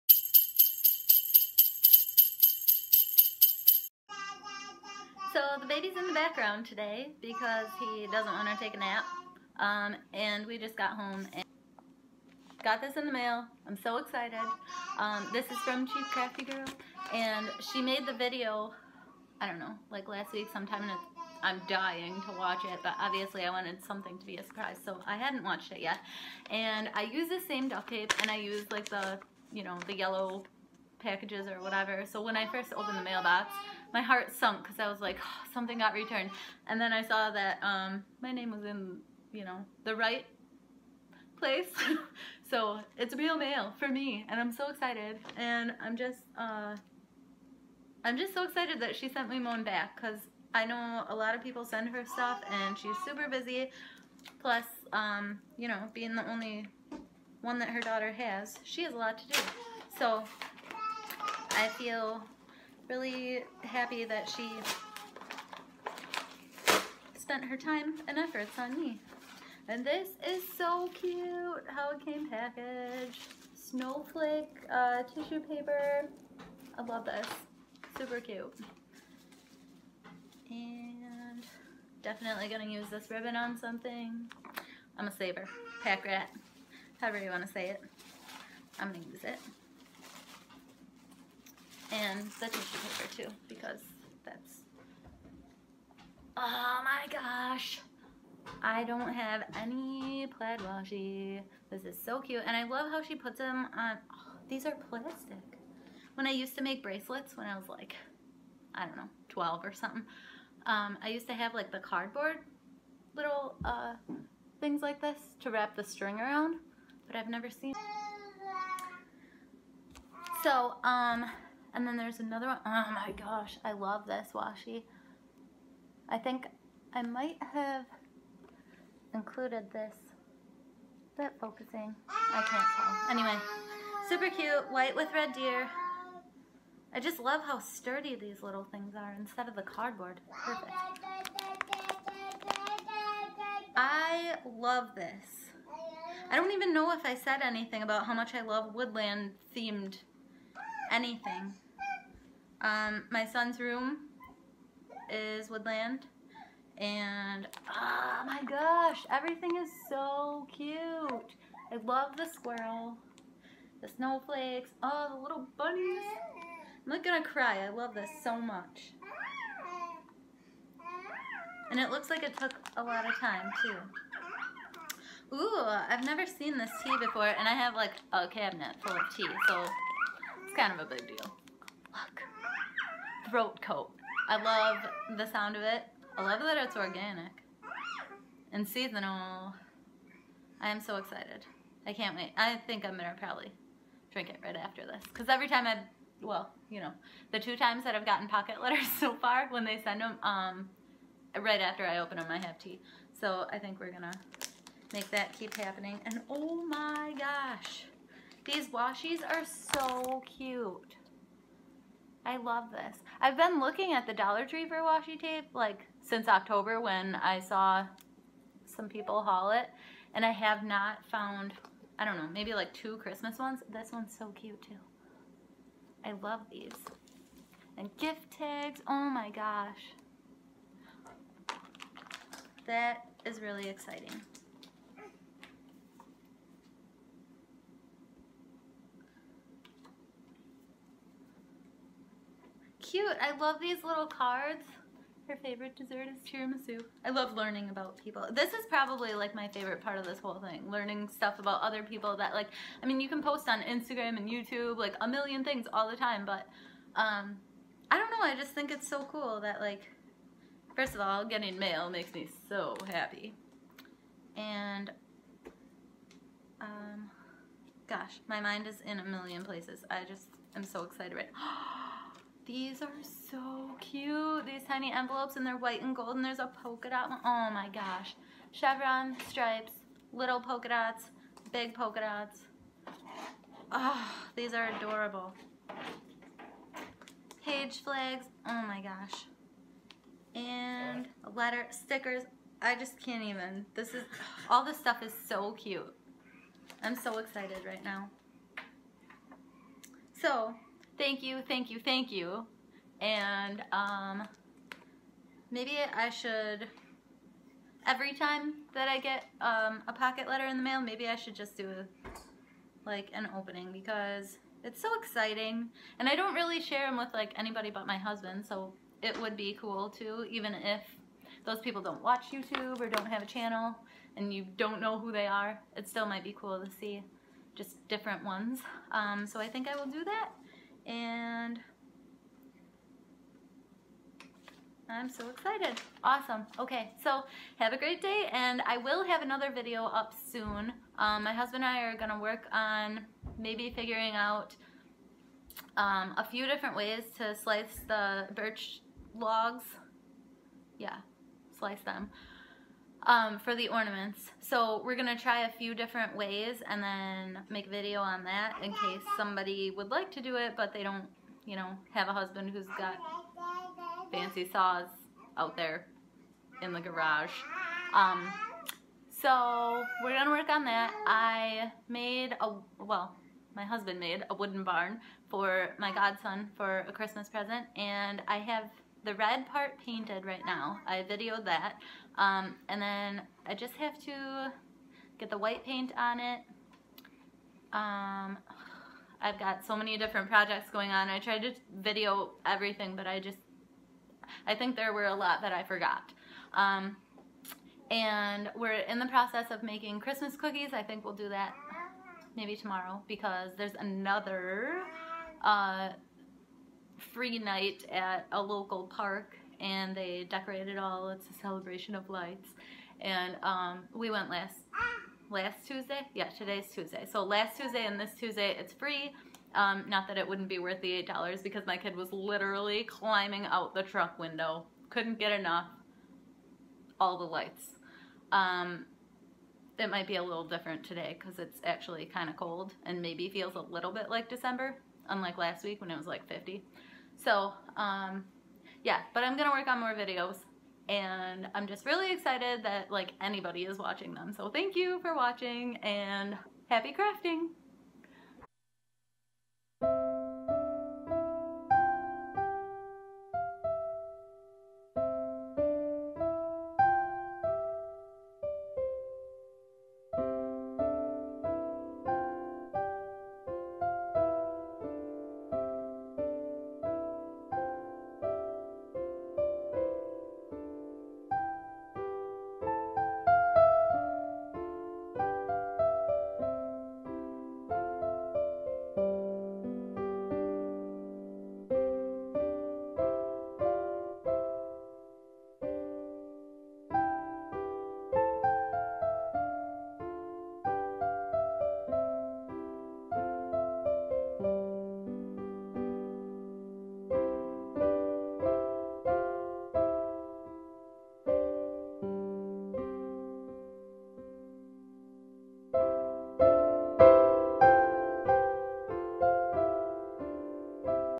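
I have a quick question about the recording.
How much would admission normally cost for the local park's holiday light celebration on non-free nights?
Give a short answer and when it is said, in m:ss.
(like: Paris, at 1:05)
$8, at 7:01.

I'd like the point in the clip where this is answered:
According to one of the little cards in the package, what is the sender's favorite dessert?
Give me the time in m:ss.
4:06.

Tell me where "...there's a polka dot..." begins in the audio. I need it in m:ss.
4:36.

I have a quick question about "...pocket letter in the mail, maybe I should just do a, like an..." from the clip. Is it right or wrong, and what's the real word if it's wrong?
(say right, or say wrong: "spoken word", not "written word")
right.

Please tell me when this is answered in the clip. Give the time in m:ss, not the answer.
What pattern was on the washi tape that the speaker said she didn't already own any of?
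1:40.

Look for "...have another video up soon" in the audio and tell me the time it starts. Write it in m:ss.
5:39.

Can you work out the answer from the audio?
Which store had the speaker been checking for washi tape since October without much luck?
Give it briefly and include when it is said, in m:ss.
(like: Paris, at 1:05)
Dollar Tree, at 3:34.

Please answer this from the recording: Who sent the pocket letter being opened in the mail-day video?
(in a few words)
Chief Crafty Girl.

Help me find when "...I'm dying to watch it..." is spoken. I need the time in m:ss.
0:21.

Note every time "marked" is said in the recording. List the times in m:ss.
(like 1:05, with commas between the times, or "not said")
not said.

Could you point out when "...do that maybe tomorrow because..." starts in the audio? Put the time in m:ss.
6:41.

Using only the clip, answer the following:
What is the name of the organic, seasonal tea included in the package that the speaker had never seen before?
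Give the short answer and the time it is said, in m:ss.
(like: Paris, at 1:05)
Throat Coat, at 3:03.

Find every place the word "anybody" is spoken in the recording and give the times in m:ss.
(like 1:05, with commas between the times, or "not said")
5:17, 7:23.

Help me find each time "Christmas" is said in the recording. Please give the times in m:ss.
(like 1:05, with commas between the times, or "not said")
3:42, 6:16, 6:39.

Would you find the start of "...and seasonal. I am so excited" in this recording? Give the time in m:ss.
3:08.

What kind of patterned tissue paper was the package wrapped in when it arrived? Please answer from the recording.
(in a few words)
Snowflake.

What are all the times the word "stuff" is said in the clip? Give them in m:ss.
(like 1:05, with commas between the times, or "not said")
0:52, 4:11, 4:54.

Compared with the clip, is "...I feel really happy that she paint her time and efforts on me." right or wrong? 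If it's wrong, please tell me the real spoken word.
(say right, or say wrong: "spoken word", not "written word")
wrong: "spent", not "paint".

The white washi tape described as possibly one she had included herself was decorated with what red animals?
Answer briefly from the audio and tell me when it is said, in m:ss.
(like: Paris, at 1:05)
Deer, at 2:15.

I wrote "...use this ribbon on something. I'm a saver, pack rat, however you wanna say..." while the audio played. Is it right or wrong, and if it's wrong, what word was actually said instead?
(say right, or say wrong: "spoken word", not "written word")
right.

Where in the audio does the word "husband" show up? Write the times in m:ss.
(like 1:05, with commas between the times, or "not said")
5:17, 5:41, 6:02, 6:13.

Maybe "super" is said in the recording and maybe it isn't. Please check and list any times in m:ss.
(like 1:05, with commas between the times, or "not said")
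0:53, 1:17, 2:14.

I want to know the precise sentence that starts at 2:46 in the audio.
I'm not gonna cry, I love this so much.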